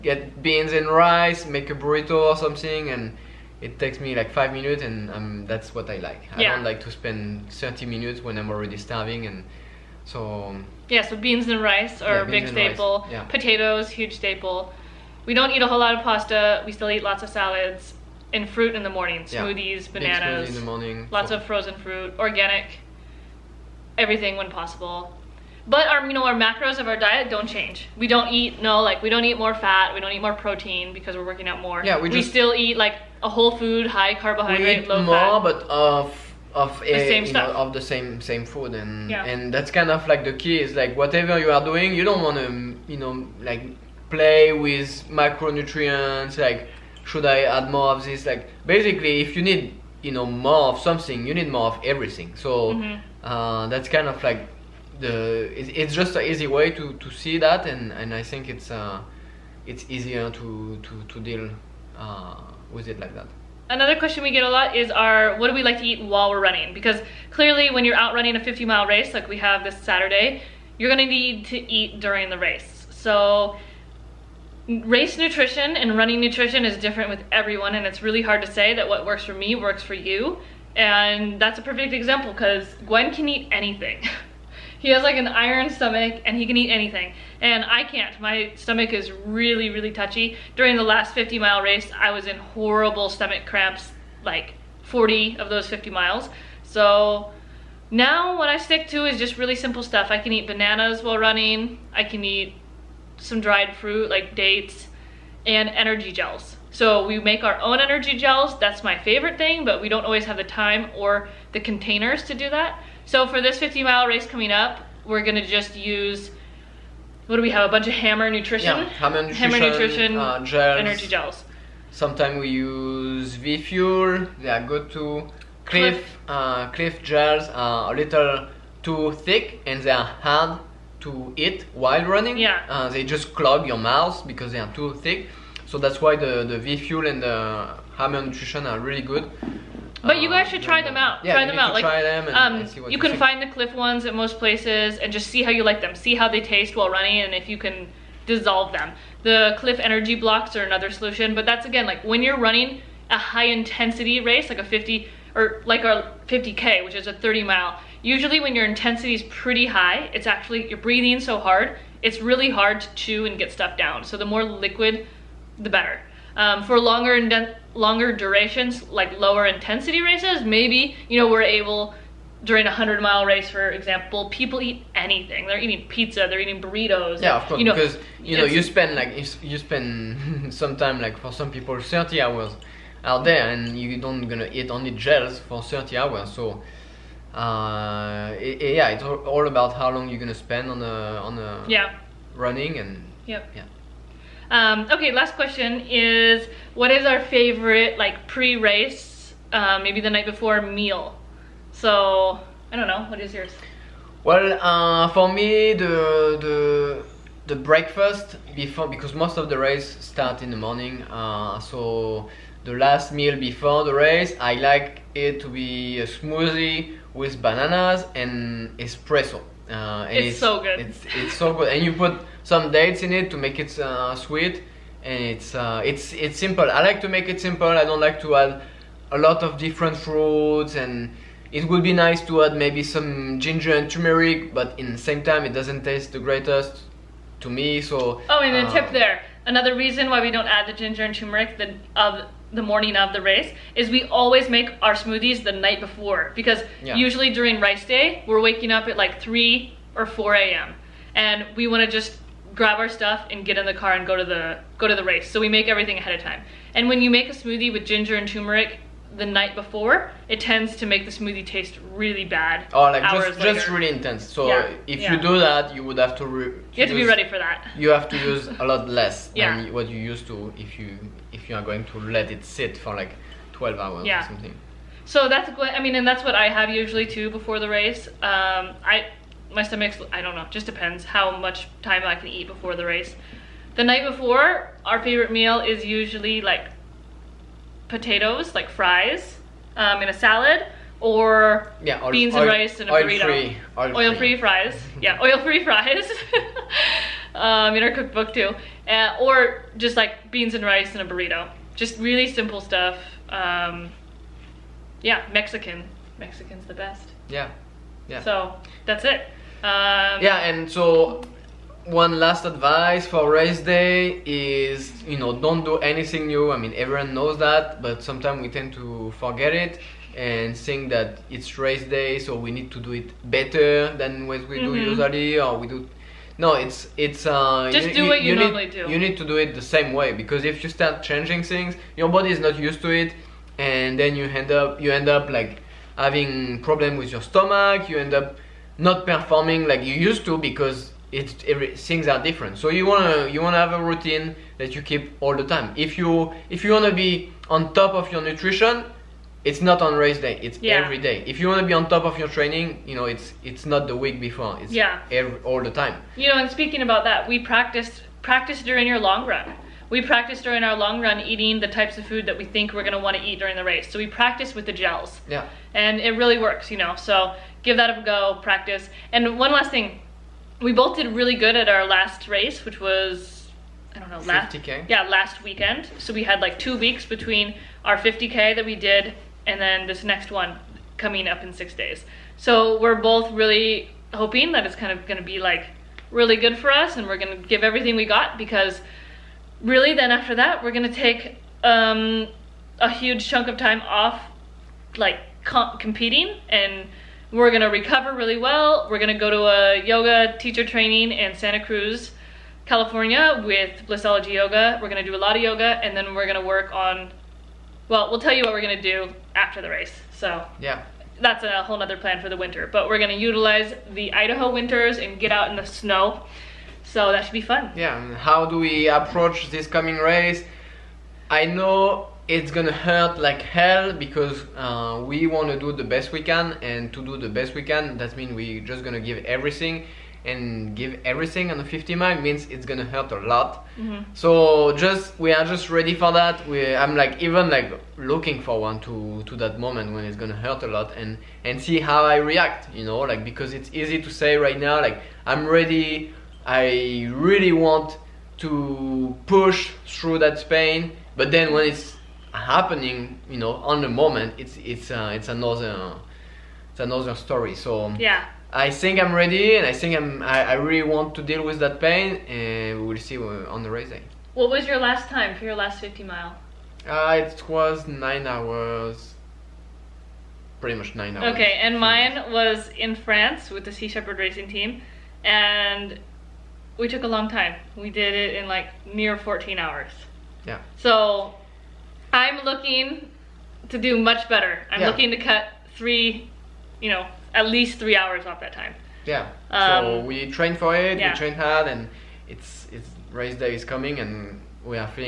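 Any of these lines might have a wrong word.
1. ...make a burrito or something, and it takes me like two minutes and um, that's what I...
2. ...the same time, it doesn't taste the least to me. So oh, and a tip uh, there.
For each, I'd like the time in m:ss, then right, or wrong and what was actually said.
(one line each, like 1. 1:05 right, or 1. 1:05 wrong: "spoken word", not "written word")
1. 0:01 wrong: "five", not "two"
2. 3:54 wrong: "greatest", not "least".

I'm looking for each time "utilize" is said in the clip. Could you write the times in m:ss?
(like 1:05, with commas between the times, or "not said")
6:53.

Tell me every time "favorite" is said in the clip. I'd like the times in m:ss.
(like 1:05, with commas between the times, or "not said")
1:48, 3:17, 4:45.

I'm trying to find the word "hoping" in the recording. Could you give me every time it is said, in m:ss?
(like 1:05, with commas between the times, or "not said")
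6:24.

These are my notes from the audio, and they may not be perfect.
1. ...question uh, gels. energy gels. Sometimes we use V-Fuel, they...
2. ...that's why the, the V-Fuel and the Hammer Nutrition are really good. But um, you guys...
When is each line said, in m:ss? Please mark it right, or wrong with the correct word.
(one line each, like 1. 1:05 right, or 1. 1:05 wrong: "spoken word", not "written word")
1. 1:59 wrong: "nutrition", not "question"
2. 2:15 right.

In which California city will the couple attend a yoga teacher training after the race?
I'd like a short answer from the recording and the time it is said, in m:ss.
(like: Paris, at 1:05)
Santa Cruz, at 6:41.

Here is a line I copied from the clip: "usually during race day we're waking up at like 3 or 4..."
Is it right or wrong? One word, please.
right.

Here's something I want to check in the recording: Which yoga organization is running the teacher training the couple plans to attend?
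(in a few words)
Blissology Yoga.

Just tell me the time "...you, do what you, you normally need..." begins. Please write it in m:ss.
5:27.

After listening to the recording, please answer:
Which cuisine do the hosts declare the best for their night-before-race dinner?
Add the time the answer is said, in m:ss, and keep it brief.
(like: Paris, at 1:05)
Mexican, at 5:06.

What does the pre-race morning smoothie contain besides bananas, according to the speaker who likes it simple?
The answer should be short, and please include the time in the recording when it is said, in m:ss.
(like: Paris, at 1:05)
Espresso, at 3:38.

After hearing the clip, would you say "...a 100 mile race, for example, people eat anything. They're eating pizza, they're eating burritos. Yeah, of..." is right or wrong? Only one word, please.
right.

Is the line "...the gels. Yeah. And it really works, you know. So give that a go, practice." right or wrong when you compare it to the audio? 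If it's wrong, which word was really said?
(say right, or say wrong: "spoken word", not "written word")
right.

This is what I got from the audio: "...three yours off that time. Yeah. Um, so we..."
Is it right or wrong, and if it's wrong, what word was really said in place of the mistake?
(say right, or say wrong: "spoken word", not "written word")
wrong: "hours", not "yours".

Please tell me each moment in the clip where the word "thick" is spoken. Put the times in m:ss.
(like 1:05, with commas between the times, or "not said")
2:09, 2:14.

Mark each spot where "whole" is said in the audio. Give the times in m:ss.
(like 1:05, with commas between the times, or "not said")
0:15, 0:33, 6:51.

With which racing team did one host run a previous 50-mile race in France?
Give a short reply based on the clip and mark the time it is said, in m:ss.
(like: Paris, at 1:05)
Sea Shepherd Racing Team, at 7:53.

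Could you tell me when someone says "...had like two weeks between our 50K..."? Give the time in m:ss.
6:16.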